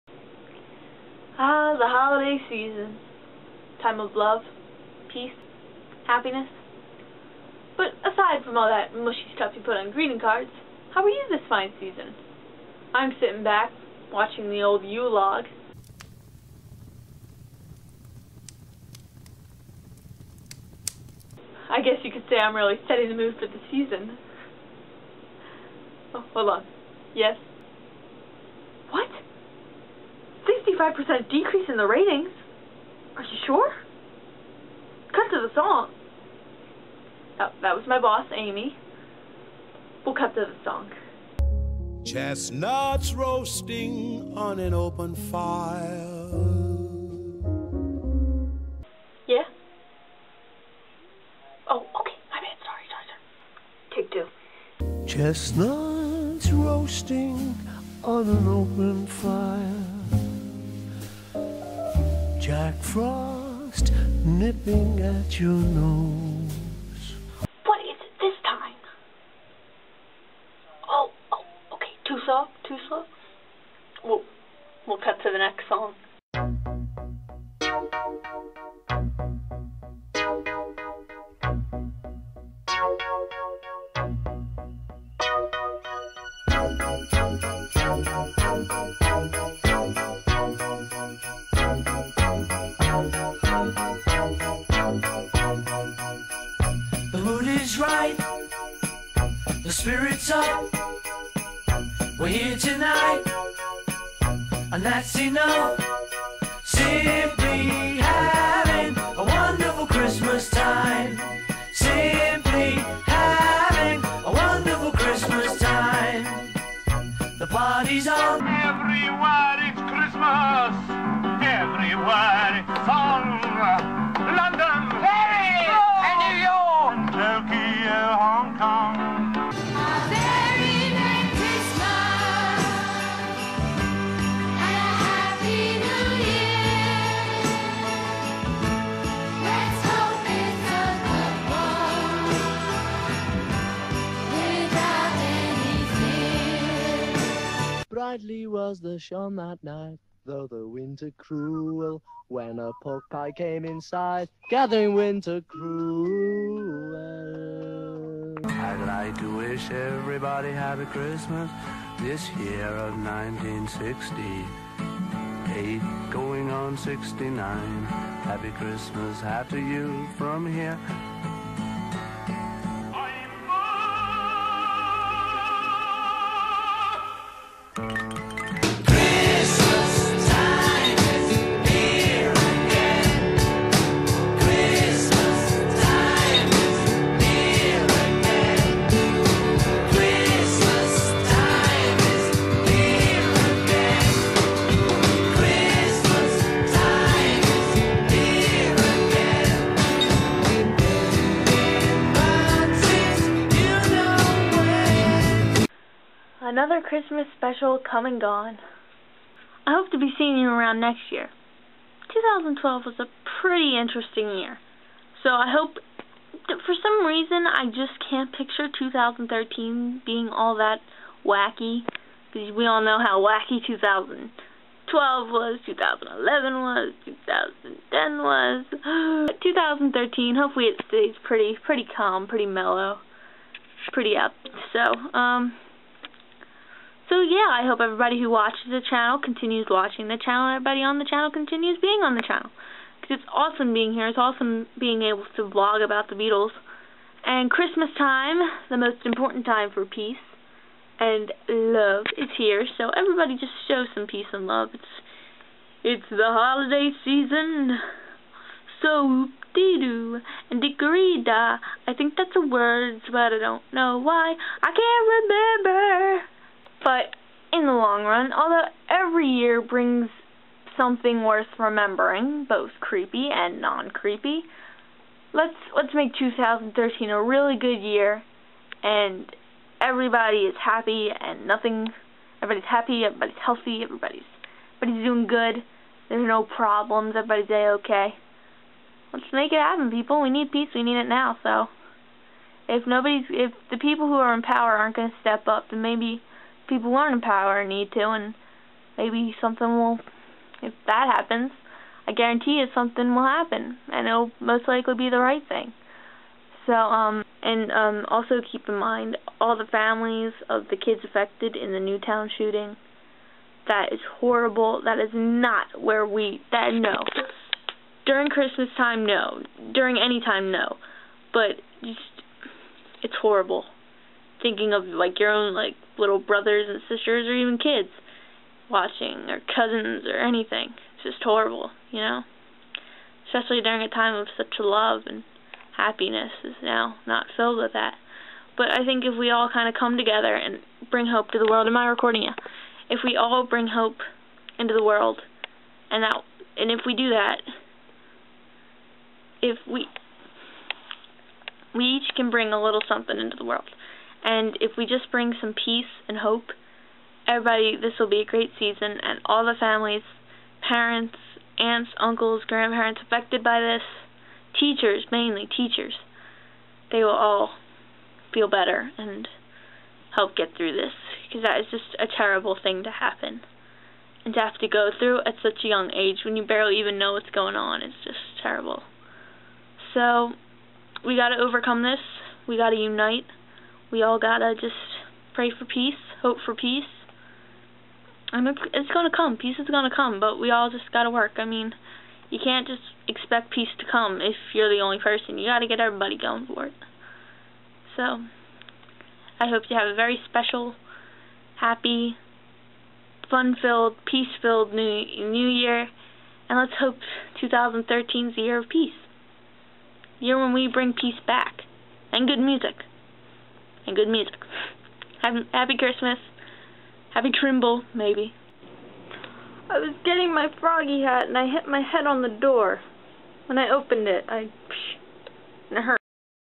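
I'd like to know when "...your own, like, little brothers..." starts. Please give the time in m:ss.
5:25.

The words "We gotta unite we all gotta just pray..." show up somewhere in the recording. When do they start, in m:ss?
6:22.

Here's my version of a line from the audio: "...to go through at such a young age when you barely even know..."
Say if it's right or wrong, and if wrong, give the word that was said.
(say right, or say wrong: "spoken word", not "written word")
right.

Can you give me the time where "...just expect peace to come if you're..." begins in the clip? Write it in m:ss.
6:32.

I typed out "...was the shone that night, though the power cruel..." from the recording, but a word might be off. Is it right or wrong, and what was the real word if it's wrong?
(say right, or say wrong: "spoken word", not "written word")
wrong: "winter", not "power".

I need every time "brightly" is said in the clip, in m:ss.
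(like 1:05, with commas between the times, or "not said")
2:28.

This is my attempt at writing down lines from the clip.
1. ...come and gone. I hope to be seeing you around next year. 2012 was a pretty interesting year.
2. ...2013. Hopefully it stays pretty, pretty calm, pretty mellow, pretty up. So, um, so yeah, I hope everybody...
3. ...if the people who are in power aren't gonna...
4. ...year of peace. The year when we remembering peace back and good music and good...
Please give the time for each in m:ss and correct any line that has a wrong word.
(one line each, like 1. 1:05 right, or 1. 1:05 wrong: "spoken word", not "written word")
1. 3:27 right
2. 3:49 right
3. 4:53 right
4. 6:48 wrong: "bring", not "remembering".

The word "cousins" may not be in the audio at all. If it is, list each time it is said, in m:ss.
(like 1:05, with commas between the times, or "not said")
5:29.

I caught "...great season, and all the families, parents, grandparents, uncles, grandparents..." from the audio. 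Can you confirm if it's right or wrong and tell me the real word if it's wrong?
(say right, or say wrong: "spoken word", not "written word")
wrong: "aunts", not "grandparents".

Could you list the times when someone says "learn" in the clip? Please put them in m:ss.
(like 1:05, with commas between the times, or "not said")
4:56.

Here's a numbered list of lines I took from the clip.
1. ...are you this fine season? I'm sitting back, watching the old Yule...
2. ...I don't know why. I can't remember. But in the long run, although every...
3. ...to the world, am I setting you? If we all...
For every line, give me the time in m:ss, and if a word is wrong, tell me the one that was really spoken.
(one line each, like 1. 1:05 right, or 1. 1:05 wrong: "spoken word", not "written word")
1. 0:11 right
2. 4:23 right
3. 5:41 wrong: "recording", not "setting".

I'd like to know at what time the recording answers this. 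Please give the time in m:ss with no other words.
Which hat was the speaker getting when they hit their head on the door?
7:00.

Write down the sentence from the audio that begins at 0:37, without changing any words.
That, that was my boss, Amy.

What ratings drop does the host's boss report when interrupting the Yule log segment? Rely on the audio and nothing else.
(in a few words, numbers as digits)
5 percent.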